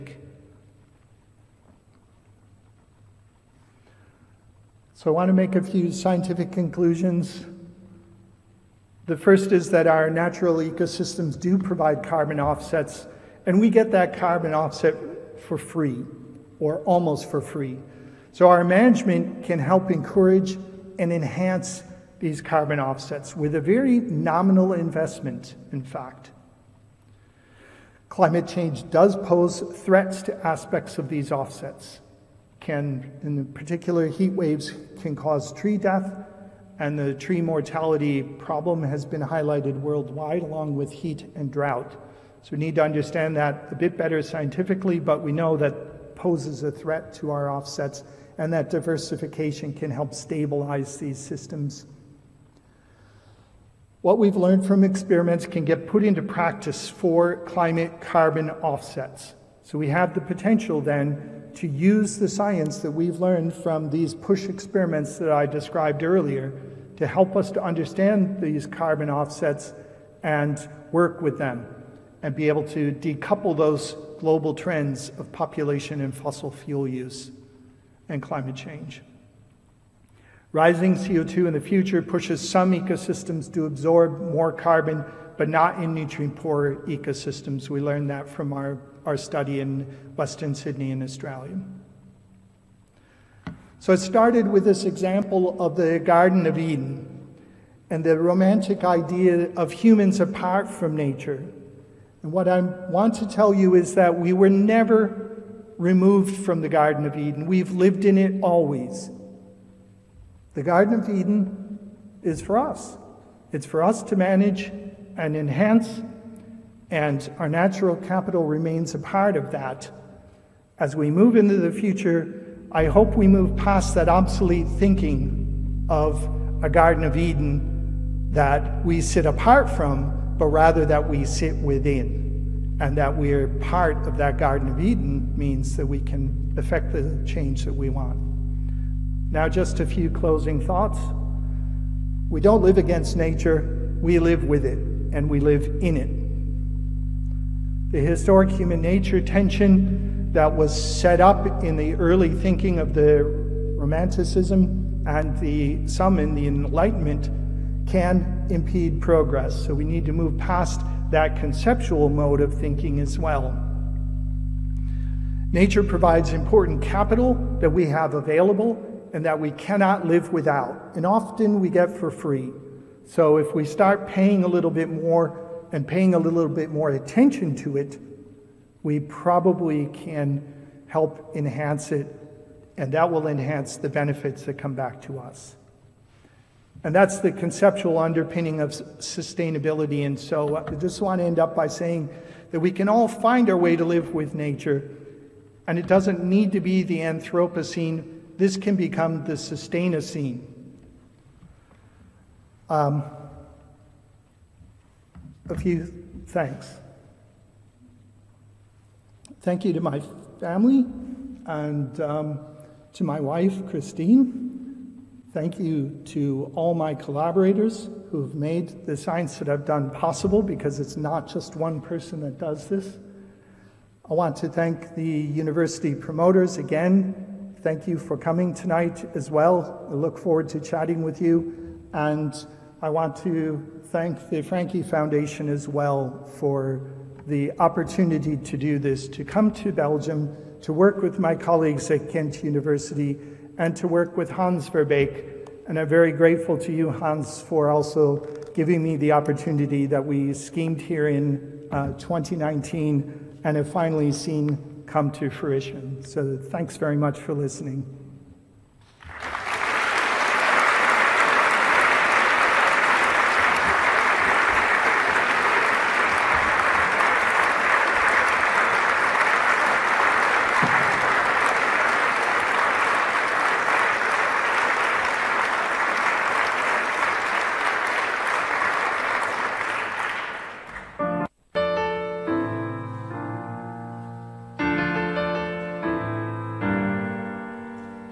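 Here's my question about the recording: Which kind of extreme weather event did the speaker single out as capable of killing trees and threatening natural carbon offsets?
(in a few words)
heat waves.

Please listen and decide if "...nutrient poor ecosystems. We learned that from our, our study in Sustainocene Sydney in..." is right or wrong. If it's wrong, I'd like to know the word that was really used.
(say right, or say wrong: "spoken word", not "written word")
wrong: "Western", not "Sustainocene".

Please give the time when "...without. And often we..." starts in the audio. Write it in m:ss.
2:50.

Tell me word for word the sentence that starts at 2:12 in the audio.
And that we're part of that Garden of Eden means that we can affect the change that we want.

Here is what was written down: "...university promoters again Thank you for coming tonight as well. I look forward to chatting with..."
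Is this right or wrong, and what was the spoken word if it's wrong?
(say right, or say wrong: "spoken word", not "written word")
right.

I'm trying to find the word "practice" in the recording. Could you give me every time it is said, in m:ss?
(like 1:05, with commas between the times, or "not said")
0:56.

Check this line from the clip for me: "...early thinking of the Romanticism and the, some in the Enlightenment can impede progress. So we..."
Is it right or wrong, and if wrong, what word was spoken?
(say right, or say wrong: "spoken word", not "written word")
right.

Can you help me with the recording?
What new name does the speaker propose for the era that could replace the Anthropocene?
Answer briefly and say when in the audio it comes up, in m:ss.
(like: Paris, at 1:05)
Sustainocene, at 3:19.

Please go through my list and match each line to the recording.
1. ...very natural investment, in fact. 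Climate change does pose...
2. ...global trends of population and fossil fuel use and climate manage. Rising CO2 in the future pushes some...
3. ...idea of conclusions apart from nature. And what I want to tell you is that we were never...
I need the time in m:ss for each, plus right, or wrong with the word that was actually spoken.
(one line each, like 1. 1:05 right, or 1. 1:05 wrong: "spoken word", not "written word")
1. 0:23 wrong: "nominal", not "natural"
2. 1:14 wrong: "change", not "manage"
3. 1:38 wrong: "humans", not "conclusions".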